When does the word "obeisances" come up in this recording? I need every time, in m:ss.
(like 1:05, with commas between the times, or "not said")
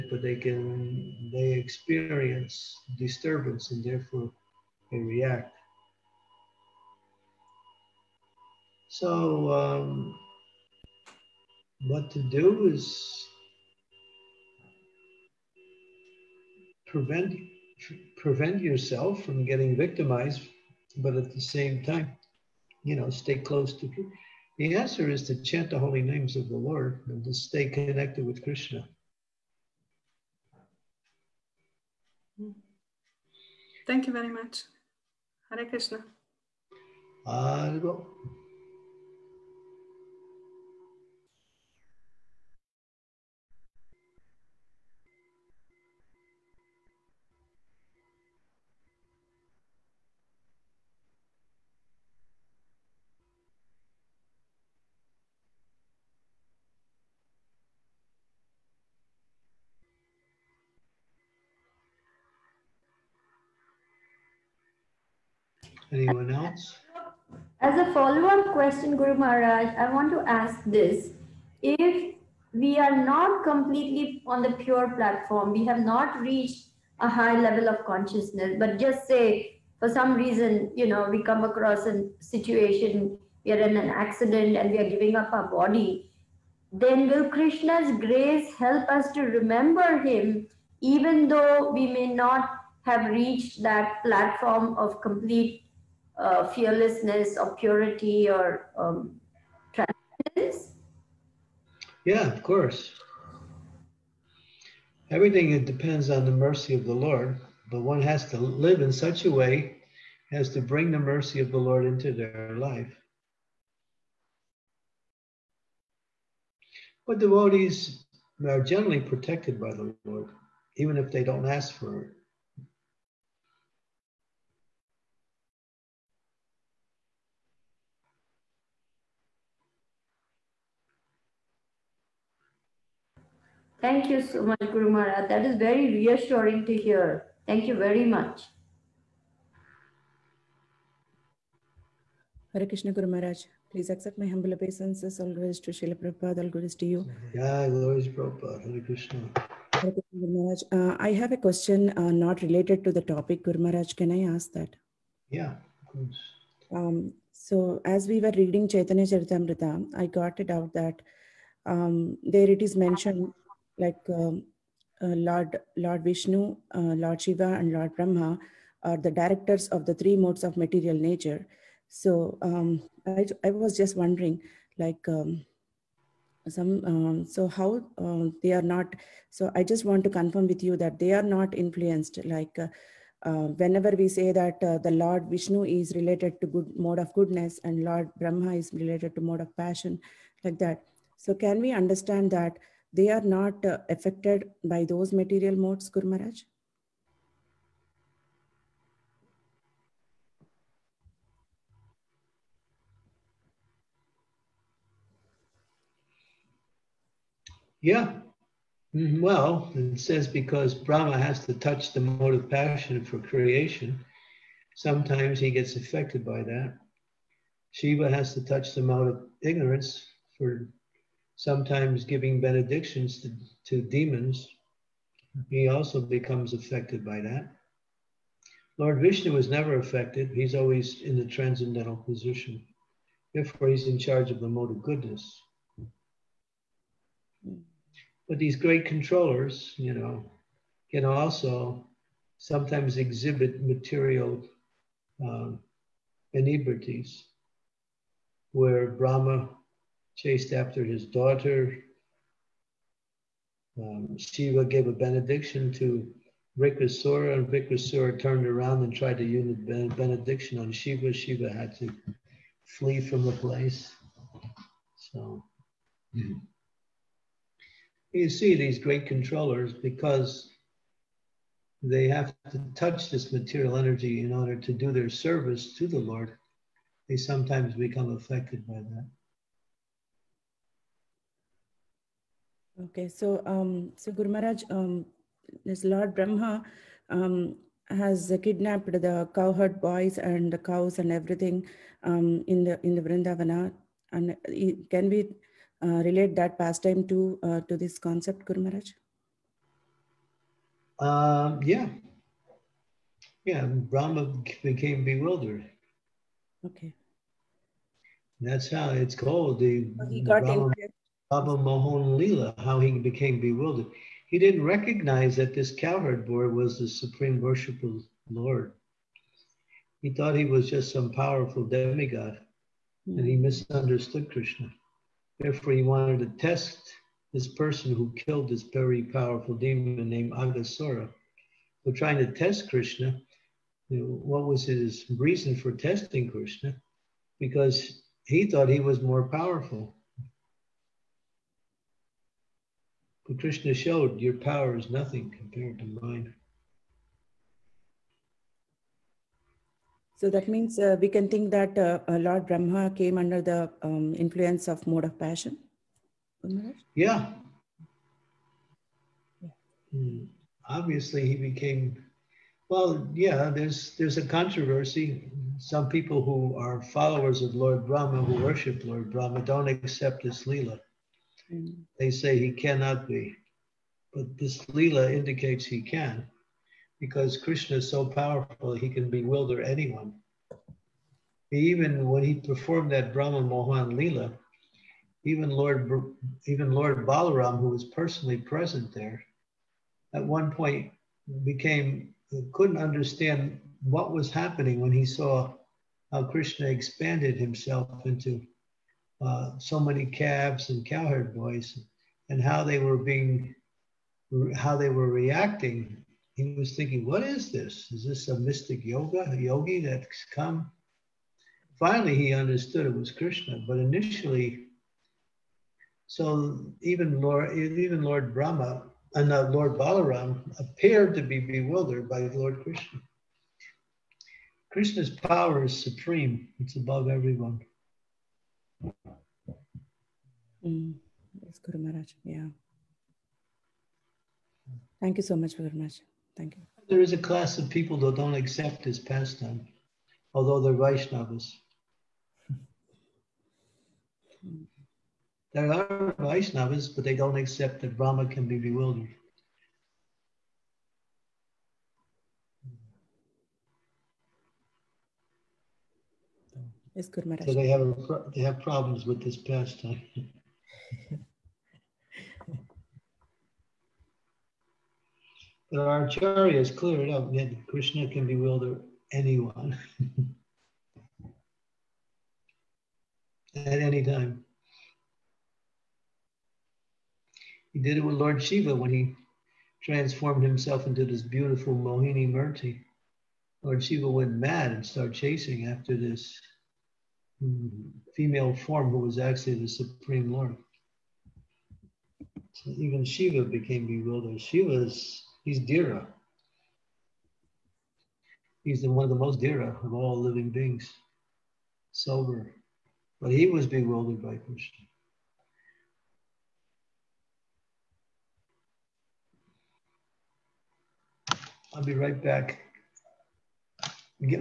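2:24.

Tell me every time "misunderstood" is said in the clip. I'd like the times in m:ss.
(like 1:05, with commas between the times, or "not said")
5:23.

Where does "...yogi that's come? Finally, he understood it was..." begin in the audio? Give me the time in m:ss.
6:49.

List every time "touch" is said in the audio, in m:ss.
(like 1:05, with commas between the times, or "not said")
3:31, 3:38, 4:32.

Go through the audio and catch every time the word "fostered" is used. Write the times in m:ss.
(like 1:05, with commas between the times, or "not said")
not said.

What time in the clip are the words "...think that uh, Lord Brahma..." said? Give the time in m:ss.
5:51.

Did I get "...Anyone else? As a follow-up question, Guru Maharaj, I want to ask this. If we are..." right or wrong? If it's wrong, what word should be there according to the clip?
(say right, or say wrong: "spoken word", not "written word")
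right.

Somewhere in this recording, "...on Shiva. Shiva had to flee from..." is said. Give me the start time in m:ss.
4:20.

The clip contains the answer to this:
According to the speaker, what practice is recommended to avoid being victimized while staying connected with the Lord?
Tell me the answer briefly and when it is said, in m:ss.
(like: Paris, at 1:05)
Chant the holy names, at 0:25.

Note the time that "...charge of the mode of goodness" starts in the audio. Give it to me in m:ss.
3:53.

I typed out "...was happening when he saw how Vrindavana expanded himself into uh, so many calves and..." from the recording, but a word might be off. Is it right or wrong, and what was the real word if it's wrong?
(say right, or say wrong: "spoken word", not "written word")
wrong: "Krishna", not "Vrindavana".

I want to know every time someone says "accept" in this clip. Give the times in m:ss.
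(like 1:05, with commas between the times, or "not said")
2:23, 6:09, 7:18, 7:27.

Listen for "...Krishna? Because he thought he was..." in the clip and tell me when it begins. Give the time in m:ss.
5:36.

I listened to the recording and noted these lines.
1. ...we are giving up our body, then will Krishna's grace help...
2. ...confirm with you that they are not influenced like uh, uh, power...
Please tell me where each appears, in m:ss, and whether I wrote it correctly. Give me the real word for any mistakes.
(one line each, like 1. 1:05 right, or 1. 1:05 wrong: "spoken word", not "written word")
1. 1:24 right
2. 3:00 wrong: "whenever", not "power".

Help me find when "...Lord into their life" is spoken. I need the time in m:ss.
1:51.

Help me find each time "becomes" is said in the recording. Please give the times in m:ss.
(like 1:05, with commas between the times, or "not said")
3:46, 4:37.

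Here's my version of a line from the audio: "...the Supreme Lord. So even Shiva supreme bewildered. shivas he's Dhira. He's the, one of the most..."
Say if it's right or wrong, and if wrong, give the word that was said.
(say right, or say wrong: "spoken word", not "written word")
wrong: "became", not "supreme".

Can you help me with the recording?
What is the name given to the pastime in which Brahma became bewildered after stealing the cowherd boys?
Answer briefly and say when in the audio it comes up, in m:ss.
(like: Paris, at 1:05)
Brahma Mohan Lila, at 5:11.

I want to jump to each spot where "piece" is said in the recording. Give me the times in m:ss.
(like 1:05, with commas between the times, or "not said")
not said.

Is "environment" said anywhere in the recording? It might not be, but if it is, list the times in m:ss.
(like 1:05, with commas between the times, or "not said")
not said.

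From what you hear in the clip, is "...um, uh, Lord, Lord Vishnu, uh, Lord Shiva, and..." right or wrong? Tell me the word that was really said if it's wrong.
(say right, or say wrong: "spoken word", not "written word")
right.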